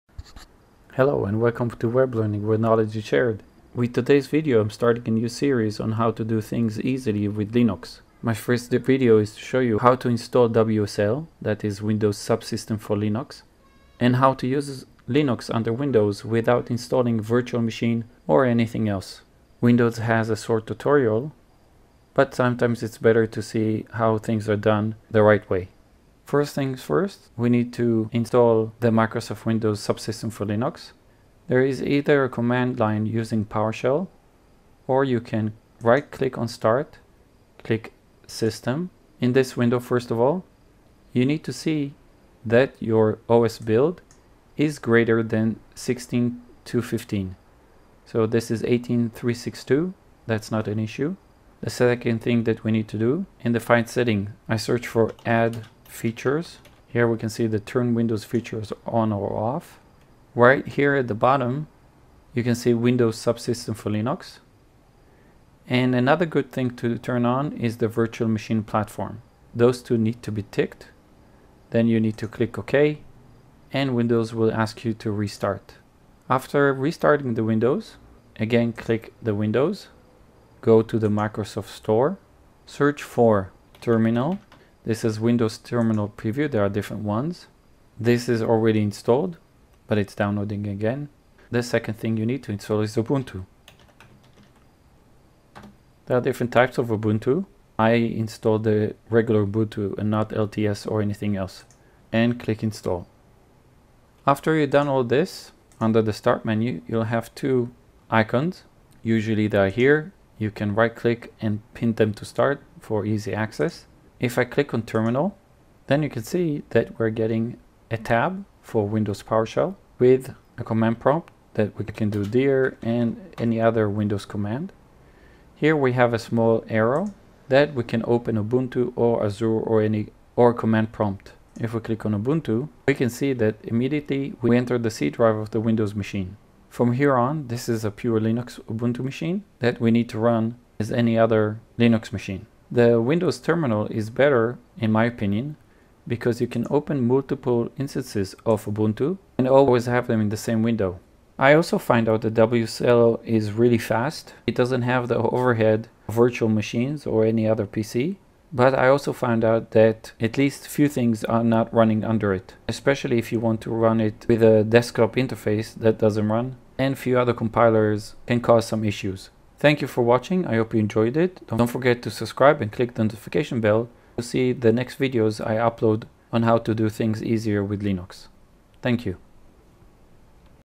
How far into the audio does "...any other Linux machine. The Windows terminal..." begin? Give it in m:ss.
2:20.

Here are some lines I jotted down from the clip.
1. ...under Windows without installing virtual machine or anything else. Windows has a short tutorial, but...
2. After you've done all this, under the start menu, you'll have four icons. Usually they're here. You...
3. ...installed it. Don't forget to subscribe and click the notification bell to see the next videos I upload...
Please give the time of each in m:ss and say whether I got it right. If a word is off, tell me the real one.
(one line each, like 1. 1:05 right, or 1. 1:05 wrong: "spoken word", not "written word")
1. 0:15 right
2. 1:44 wrong: "two", not "four"
3. 2:50 wrong: "enjoyed", not "installed".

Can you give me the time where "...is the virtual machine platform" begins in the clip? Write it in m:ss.
1:07.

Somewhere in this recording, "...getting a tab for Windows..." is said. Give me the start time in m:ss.
1:57.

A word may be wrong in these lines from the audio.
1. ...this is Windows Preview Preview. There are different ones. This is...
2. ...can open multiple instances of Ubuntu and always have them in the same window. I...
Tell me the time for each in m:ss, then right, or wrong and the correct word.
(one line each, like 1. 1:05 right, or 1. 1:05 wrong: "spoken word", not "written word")
1. 1:24 wrong: "Terminal", not "Preview"
2. 2:26 right.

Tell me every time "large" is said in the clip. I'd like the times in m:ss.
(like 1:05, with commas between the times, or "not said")
not said.